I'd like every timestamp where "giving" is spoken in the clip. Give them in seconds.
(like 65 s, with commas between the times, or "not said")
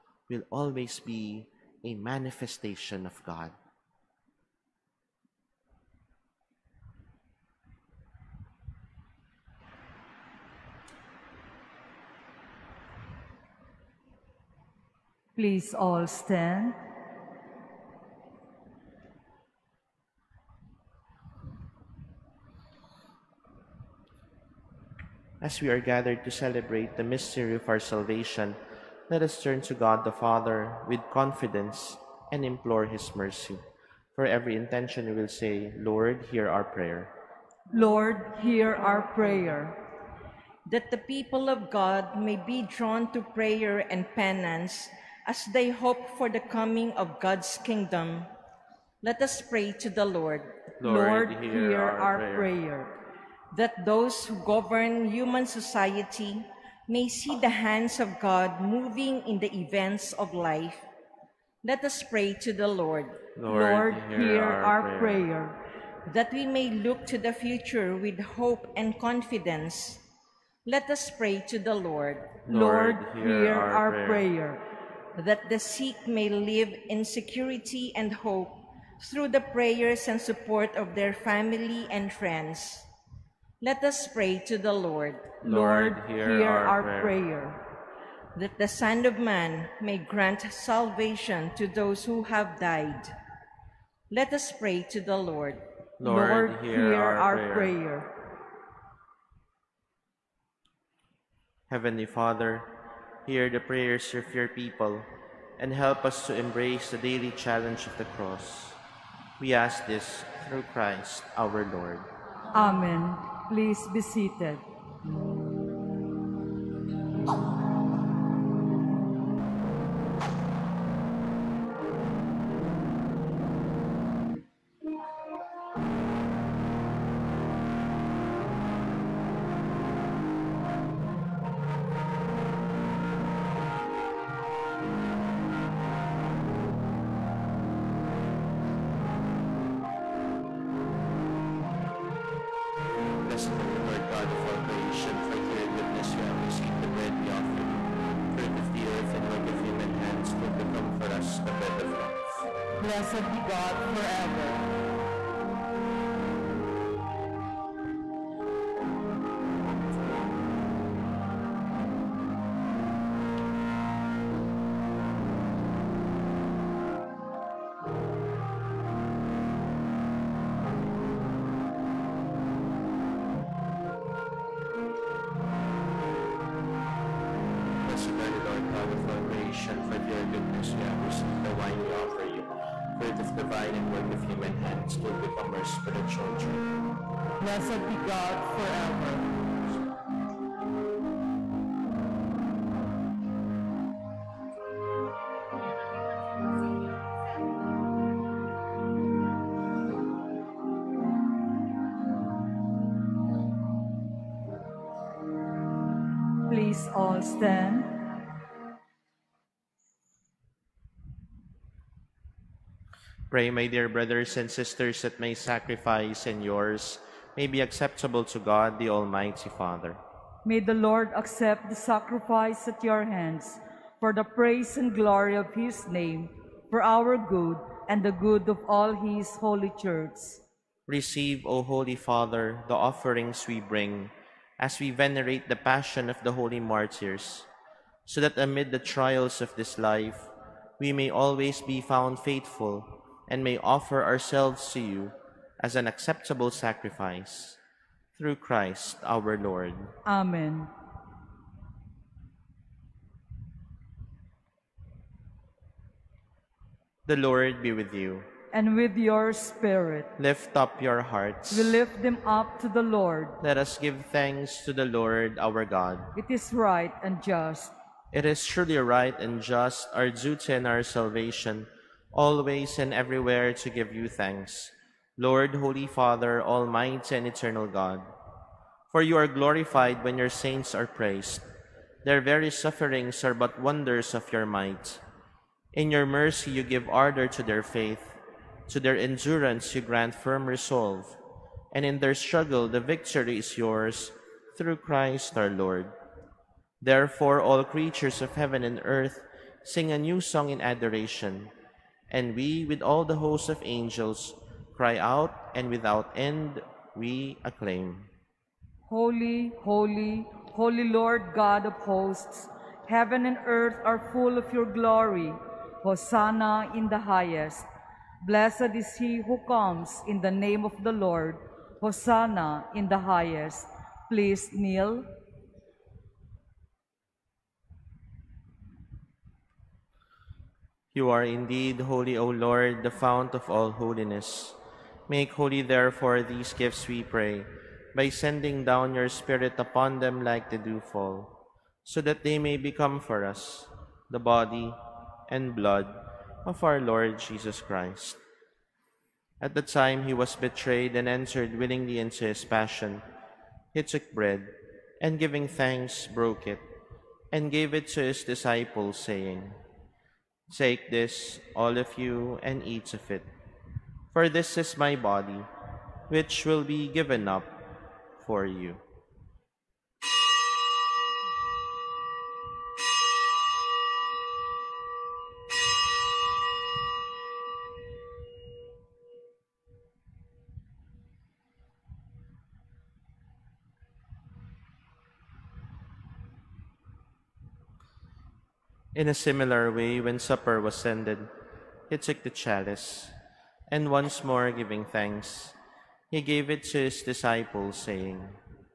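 355 s, 394 s.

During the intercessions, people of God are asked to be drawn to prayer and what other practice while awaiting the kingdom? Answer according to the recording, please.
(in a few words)
Penance.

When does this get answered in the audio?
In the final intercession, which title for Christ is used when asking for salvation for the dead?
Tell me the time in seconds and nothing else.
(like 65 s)
88 s.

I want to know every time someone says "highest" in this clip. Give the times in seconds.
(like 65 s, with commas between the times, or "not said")
316 s, 322 s.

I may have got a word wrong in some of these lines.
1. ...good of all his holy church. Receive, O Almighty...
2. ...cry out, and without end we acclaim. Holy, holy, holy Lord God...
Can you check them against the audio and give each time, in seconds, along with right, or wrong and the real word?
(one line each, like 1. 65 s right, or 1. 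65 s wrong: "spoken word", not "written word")
1. 228 s wrong: "Holy", not "Almighty"
2. 304 s right.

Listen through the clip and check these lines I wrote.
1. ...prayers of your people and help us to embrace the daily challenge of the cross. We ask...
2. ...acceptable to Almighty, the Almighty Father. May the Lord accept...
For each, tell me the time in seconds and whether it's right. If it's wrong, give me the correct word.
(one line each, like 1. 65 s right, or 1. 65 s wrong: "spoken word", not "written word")
1. 103 s right
2. 217 s wrong: "God", not "Almighty".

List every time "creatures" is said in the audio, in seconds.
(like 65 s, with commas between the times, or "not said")
297 s.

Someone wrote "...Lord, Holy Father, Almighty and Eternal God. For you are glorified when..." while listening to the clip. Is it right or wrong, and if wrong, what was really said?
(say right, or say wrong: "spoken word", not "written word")
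right.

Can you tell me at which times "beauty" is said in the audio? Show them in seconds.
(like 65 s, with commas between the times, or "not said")
not said.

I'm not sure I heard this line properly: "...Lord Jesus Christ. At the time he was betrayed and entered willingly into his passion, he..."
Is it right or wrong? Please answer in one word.
right.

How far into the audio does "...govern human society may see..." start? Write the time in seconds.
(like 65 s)
54 s.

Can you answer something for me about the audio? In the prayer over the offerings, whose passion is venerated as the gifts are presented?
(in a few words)
The holy martyrs.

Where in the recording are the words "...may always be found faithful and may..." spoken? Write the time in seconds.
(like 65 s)
240 s.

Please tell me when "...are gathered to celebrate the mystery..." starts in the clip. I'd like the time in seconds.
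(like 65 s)
25 s.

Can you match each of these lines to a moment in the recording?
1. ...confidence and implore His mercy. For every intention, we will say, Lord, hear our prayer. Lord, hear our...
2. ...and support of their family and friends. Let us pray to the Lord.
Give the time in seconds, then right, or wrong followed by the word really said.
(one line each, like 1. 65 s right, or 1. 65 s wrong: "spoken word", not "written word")
1. 31 s right
2. 80 s right.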